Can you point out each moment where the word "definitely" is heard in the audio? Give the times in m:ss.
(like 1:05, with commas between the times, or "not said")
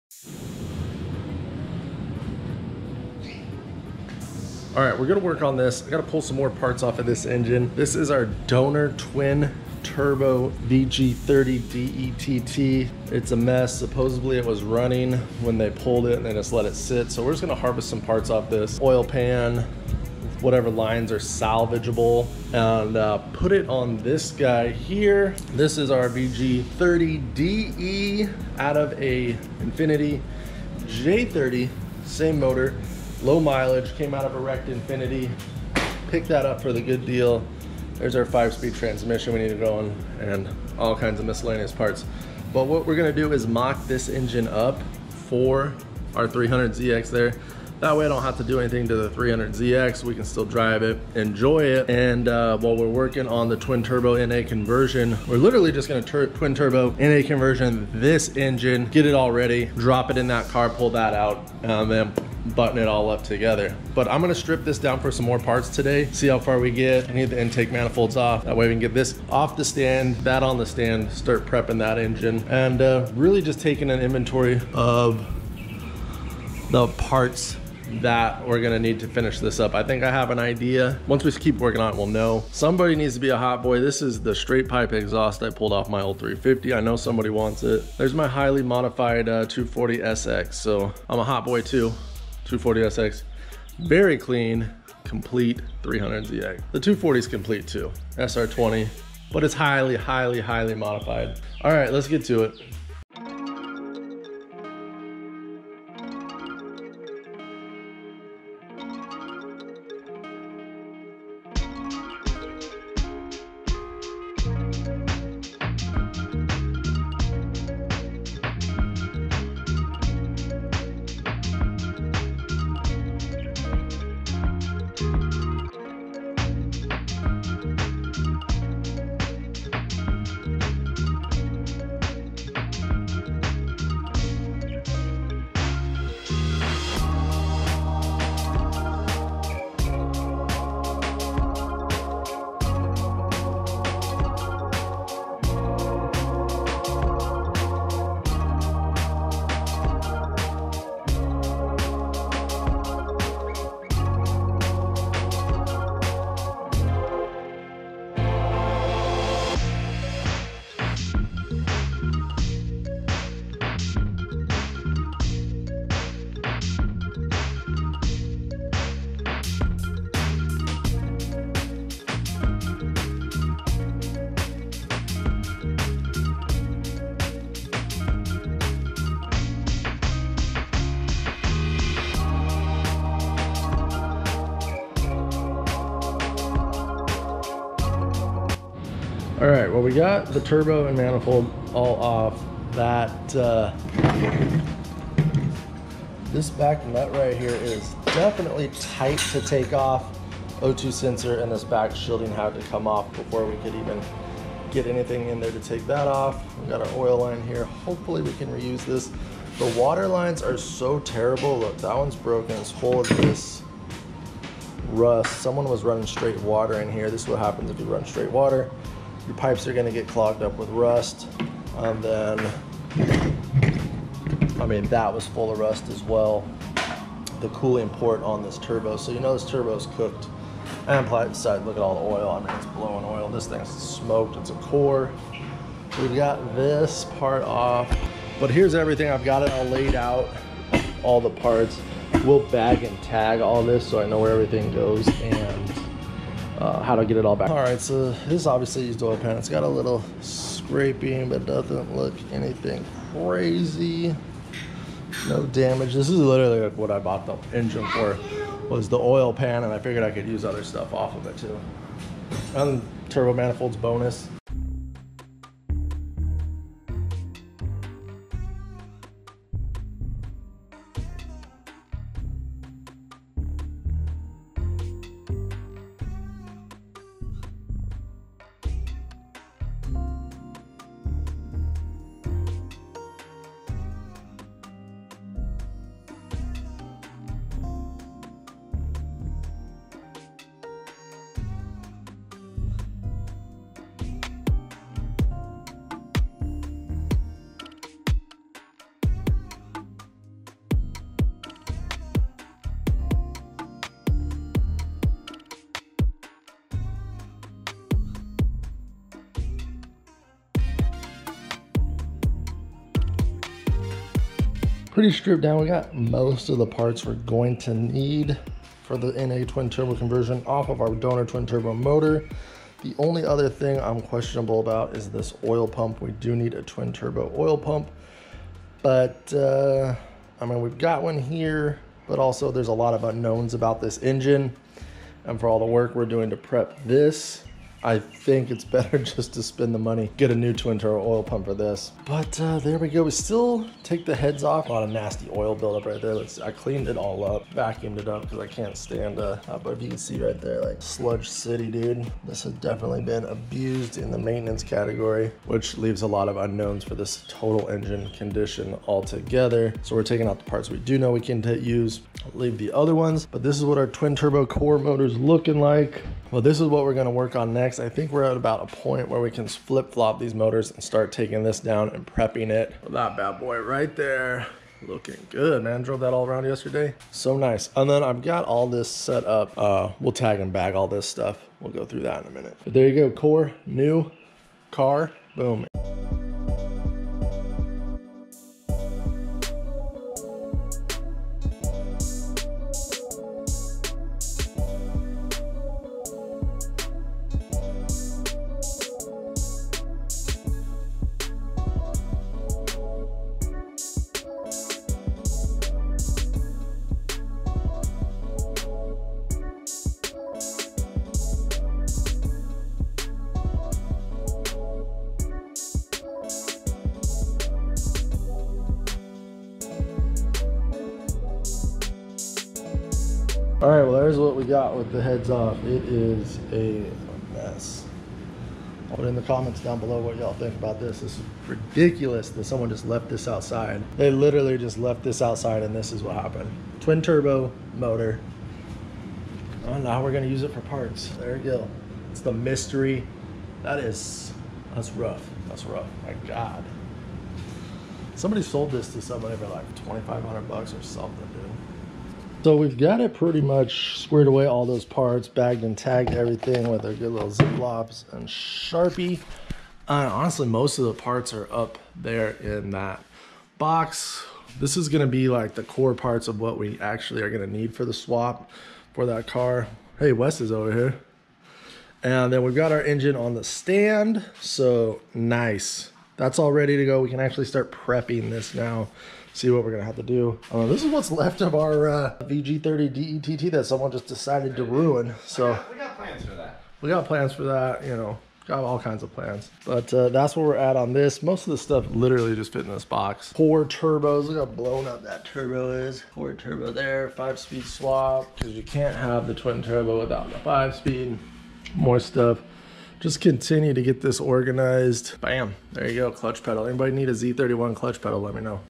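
3:18, 5:52.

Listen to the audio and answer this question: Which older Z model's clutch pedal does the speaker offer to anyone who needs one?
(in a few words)
Z31.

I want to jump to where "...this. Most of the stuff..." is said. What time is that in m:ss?
8:10.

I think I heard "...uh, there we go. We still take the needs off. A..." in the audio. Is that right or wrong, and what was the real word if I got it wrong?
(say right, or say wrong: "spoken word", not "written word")
wrong: "heads", not "needs".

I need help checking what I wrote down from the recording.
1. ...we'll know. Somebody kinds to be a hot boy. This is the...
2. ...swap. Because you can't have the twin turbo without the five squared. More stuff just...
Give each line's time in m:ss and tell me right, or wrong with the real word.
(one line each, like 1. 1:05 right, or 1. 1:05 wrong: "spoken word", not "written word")
1. 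1:21 wrong: "needs", not "kinds"
2. 8:17 wrong: "speed", not "squared".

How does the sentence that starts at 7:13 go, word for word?
They literally just left this outside and this is what happened.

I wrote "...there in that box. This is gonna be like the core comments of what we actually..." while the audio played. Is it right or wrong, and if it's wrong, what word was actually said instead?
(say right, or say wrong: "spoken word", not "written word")
wrong: "parts", not "comments".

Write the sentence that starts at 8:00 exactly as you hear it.
Uh, this is what's left of our uh, VG30 DETT that someone just decided to ruin.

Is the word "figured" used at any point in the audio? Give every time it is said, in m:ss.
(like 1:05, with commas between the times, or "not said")
4:19.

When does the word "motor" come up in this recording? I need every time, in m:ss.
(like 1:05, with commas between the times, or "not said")
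0:32, 5:21, 6:04, 6:10, 7:17.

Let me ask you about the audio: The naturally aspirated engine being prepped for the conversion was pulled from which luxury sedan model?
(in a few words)
Infiniti J30.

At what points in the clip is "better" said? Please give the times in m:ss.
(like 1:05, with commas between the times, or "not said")
5:38.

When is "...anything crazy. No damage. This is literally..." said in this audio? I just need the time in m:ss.
4:12.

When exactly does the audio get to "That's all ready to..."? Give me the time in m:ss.
7:56.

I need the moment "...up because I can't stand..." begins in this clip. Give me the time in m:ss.
5:48.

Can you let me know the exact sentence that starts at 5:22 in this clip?
The only other thing I'm questionable about is this oil pump.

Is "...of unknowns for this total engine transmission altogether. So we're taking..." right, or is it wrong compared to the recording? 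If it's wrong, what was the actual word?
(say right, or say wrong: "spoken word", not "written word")
wrong: "condition", not "transmission".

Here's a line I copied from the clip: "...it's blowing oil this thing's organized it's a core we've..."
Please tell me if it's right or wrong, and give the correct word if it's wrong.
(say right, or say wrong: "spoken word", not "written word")
wrong: "smoked", not "organized".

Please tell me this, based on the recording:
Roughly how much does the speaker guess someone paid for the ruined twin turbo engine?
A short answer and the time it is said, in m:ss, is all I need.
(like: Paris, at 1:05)
$2,500, at 7:29.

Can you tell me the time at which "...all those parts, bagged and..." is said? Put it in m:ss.
7:34.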